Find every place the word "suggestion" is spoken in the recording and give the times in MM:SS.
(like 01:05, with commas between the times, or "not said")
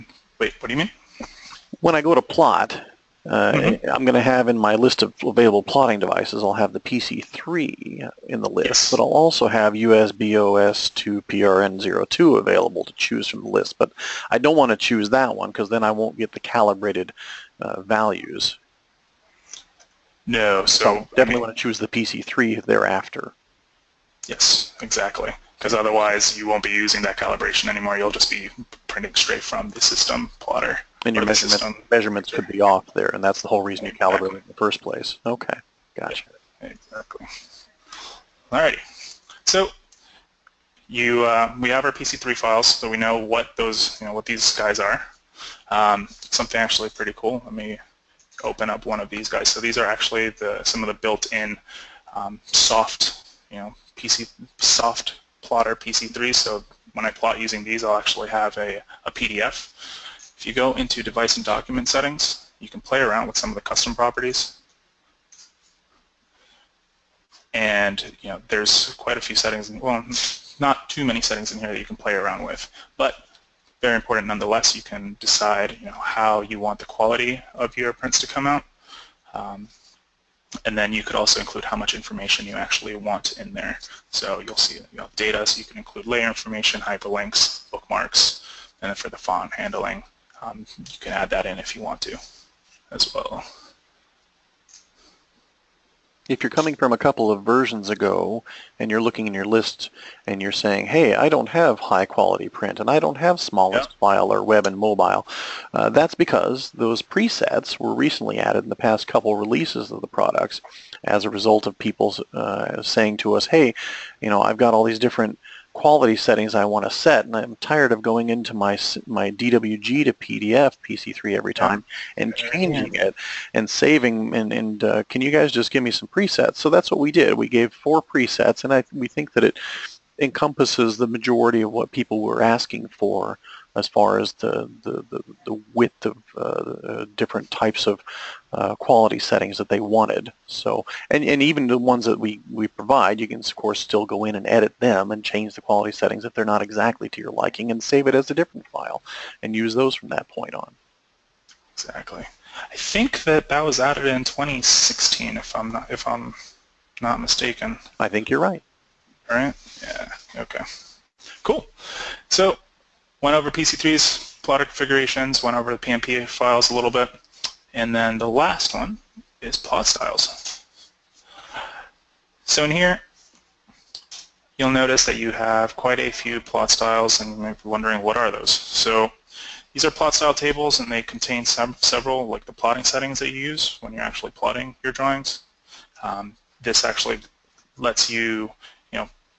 not said.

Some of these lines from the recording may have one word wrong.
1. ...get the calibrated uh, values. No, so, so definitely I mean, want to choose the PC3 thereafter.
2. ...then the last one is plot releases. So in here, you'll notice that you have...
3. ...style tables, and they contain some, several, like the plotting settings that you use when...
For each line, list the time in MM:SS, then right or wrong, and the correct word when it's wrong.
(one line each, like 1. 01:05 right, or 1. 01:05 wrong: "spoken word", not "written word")
1. 00:16 right
2. 02:47 wrong: "styles", not "releases"
3. 03:00 right.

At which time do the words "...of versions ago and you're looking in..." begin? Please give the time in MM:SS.
01:37.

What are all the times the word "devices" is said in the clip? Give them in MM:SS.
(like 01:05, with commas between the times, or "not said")
00:06, 01:01.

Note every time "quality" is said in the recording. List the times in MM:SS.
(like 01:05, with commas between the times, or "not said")
01:16, 01:42, 01:55, 02:18, 02:25.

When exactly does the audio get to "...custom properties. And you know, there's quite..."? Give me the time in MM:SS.
01:03.